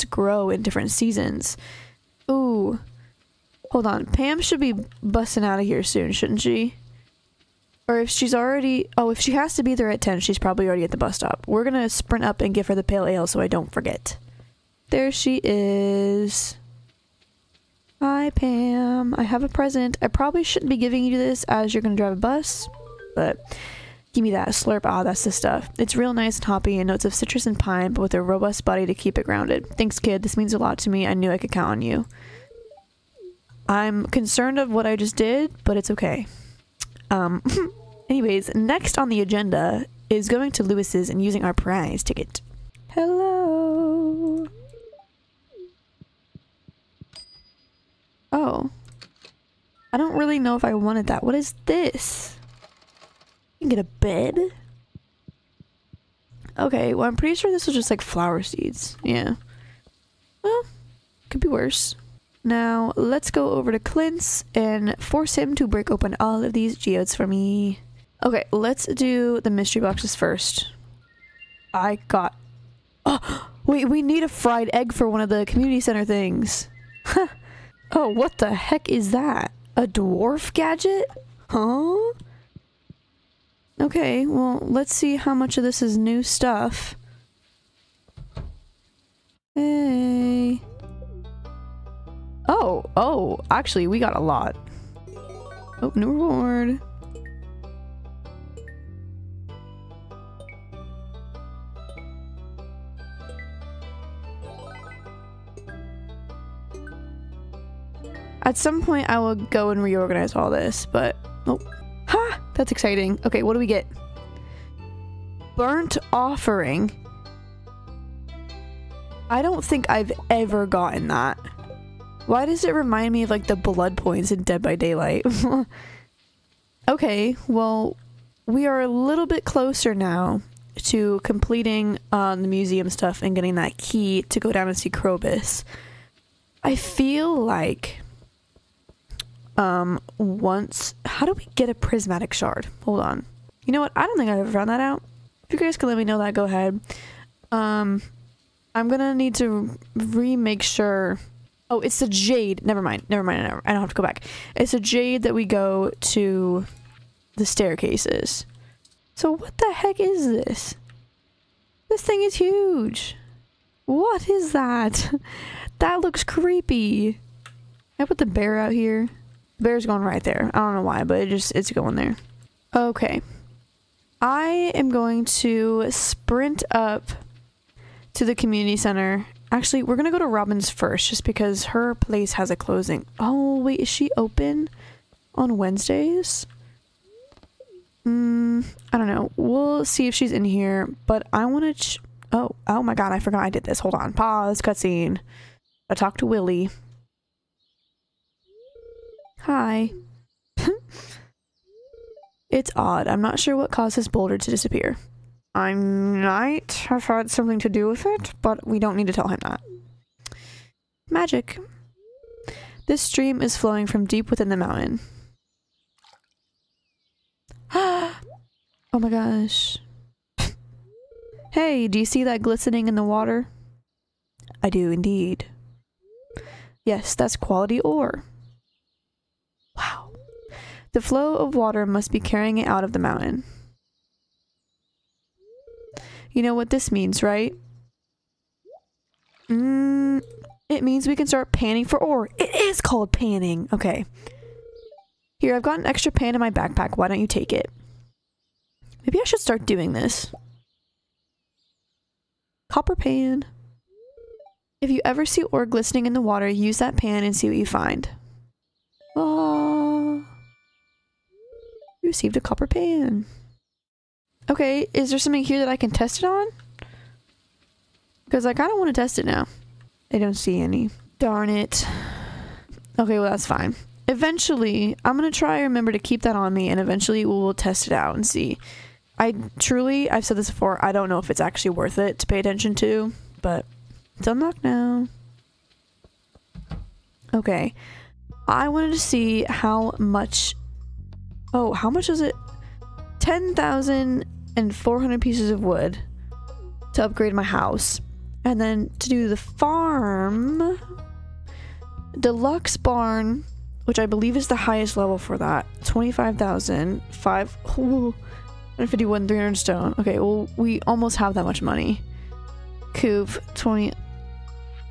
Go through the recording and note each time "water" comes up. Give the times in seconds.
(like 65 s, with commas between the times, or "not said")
223 s, 231 s, 256 s.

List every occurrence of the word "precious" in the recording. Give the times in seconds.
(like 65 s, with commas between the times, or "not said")
not said.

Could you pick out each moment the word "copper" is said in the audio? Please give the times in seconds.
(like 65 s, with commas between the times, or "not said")
252 s, 262 s.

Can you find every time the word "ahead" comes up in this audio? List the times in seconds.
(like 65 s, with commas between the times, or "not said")
146 s.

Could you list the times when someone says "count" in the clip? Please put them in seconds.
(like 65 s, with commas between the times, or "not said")
31 s.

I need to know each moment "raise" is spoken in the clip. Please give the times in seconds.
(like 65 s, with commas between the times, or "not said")
not said.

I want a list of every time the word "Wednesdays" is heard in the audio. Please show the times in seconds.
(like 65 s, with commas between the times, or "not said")
185 s.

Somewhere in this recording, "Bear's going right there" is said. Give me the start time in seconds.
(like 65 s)
169 s.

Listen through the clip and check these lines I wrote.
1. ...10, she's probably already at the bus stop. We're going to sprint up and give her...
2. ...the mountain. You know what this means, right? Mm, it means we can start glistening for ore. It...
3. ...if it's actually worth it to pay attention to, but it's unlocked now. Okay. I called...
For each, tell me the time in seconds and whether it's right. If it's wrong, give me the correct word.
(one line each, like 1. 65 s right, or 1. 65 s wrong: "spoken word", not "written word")
1. 10 s right
2. 232 s wrong: "panning", not "glistening"
3. 281 s wrong: "wanted", not "called".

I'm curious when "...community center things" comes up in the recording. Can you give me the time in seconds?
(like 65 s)
75 s.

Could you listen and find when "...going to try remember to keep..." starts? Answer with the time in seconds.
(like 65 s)
275 s.